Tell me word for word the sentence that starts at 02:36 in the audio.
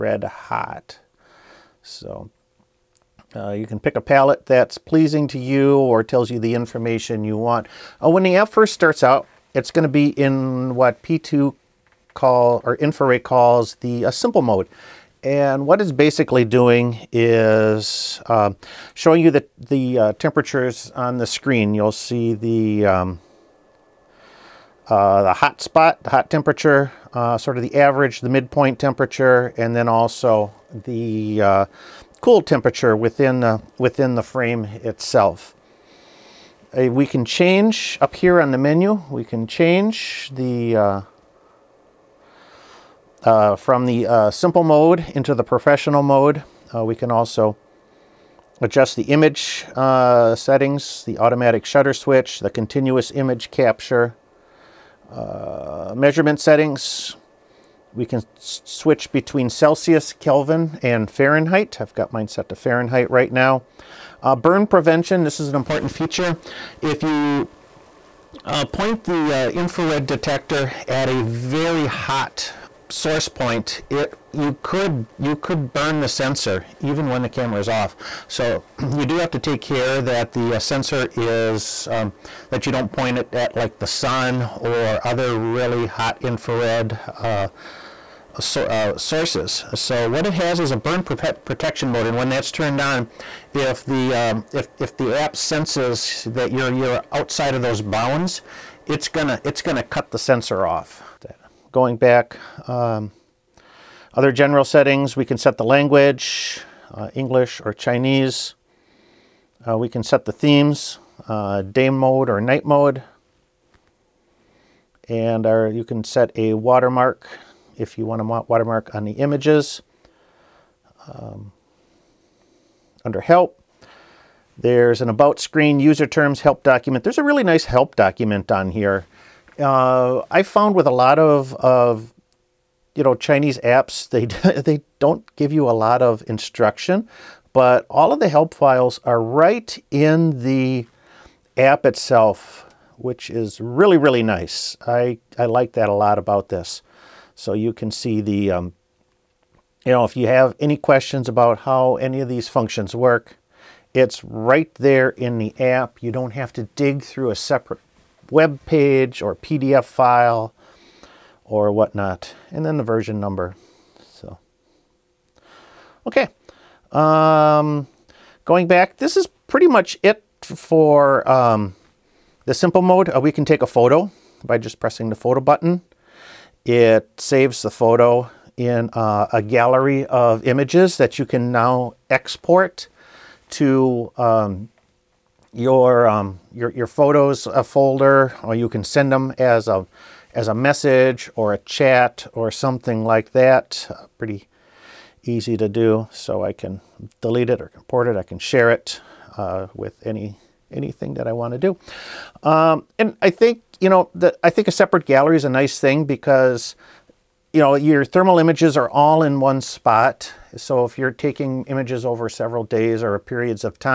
You don't have to dig through a separate web page or PDF file or whatnot.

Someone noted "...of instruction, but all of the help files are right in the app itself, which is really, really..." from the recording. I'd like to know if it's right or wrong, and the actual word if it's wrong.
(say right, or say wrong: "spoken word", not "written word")
right.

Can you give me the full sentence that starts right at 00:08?
Uh, when the app first starts out, it's going to be in what P2 call or Infiray calls the uh, simple mode.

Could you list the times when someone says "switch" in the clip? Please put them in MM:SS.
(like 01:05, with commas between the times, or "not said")
00:51, 00:58.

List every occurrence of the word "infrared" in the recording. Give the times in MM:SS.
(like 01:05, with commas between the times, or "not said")
01:09, 01:26.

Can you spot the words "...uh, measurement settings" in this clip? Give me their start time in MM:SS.
00:55.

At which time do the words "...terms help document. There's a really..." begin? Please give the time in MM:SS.
02:06.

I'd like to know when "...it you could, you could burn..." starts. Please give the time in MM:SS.
01:13.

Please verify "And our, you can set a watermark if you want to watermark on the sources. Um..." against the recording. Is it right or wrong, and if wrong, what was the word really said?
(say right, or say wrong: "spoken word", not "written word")
wrong: "images", not "sources".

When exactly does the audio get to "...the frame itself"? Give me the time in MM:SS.
00:34.